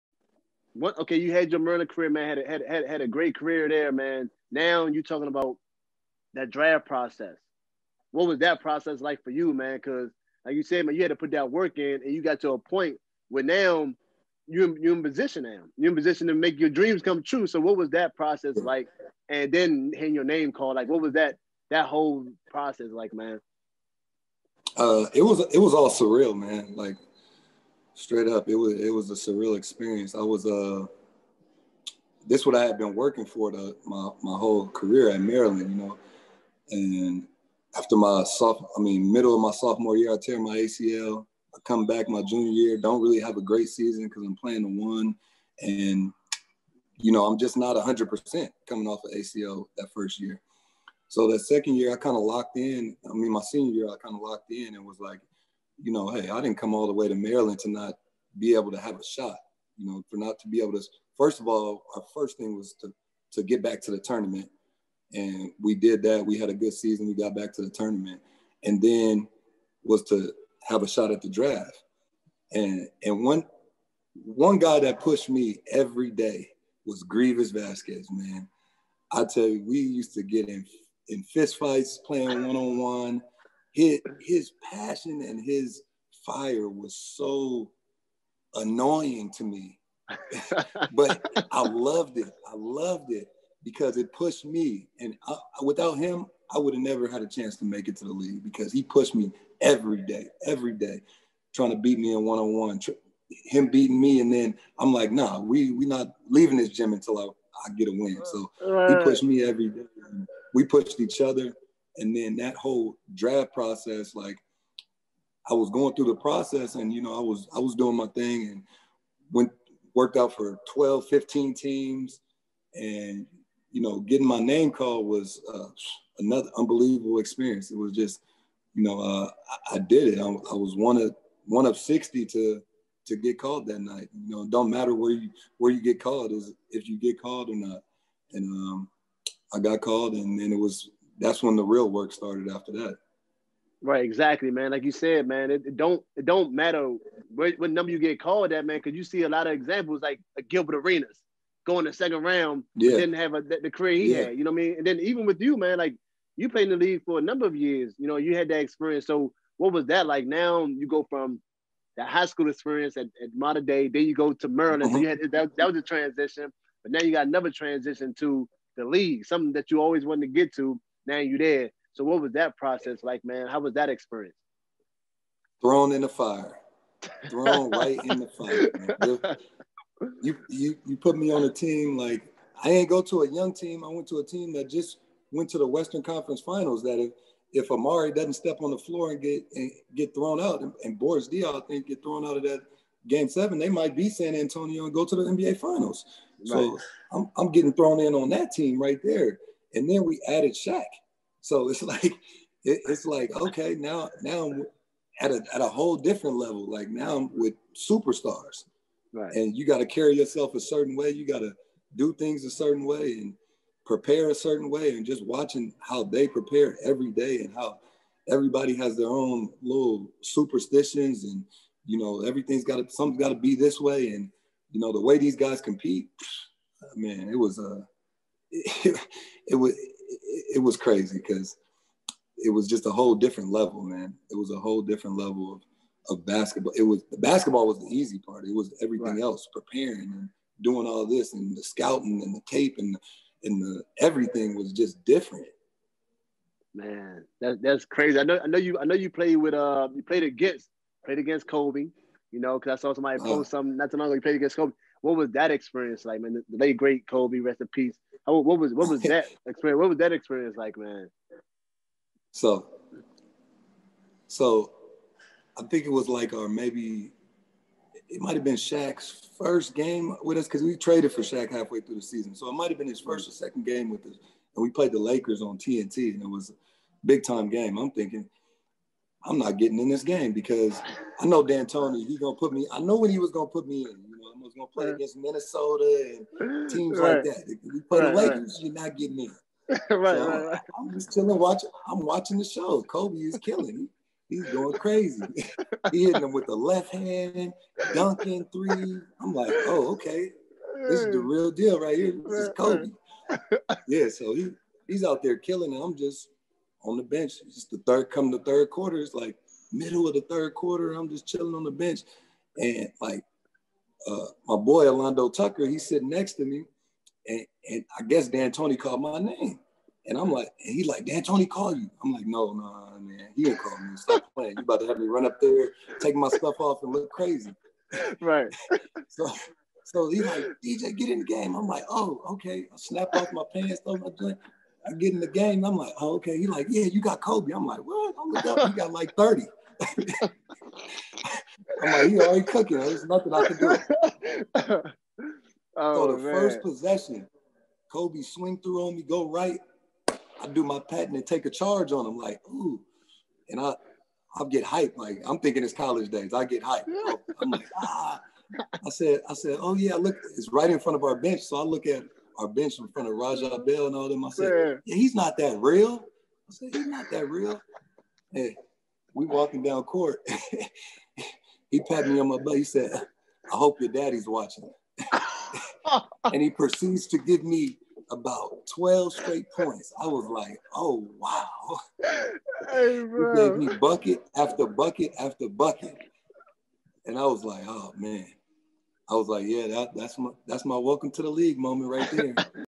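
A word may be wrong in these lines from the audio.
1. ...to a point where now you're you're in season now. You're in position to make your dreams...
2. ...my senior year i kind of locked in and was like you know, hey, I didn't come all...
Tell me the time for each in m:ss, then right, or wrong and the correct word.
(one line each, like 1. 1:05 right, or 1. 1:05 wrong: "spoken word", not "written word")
1. 0:12 wrong: "position", not "season"
2. 0:53 right.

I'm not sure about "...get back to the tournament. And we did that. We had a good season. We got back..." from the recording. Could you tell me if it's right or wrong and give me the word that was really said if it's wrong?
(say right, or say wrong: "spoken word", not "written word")
right.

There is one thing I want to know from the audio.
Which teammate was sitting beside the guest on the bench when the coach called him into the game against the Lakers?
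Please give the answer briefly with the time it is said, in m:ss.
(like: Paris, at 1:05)
Alando Tucker, at 5:14.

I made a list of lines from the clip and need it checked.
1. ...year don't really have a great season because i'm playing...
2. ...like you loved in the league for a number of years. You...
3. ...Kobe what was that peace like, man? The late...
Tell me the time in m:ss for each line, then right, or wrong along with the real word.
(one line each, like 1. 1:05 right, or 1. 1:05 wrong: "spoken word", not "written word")
1. 0:42 right
2. 2:35 wrong: "played", not "loved"
3. 4:14 wrong: "experience", not "peace".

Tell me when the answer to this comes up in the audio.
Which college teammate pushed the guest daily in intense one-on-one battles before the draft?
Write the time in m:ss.
1:17.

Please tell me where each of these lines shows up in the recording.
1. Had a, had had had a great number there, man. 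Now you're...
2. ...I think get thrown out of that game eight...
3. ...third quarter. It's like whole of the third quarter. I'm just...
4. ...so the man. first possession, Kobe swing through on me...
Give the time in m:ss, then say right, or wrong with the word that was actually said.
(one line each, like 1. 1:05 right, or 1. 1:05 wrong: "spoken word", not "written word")
1. 0:02 wrong: "career", not "number"
2. 3:11 wrong: "seven", not "eight"
3. 5:08 wrong: "middle", not "whole"
4. 5:45 right.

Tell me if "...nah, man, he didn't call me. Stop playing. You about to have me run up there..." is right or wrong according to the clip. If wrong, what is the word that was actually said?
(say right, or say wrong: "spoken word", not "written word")
right.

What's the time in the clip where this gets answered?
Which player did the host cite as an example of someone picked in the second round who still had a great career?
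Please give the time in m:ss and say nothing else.
2:30.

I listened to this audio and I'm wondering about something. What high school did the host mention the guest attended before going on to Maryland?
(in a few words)
Mater Dei.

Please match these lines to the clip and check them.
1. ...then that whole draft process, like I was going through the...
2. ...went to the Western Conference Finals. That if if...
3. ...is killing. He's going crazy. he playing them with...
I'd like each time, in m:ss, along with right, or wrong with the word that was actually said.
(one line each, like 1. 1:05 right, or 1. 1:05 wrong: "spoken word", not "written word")
1. 1:52 right
2. 3:05 right
3. 4:53 wrong: "hitting", not "playing".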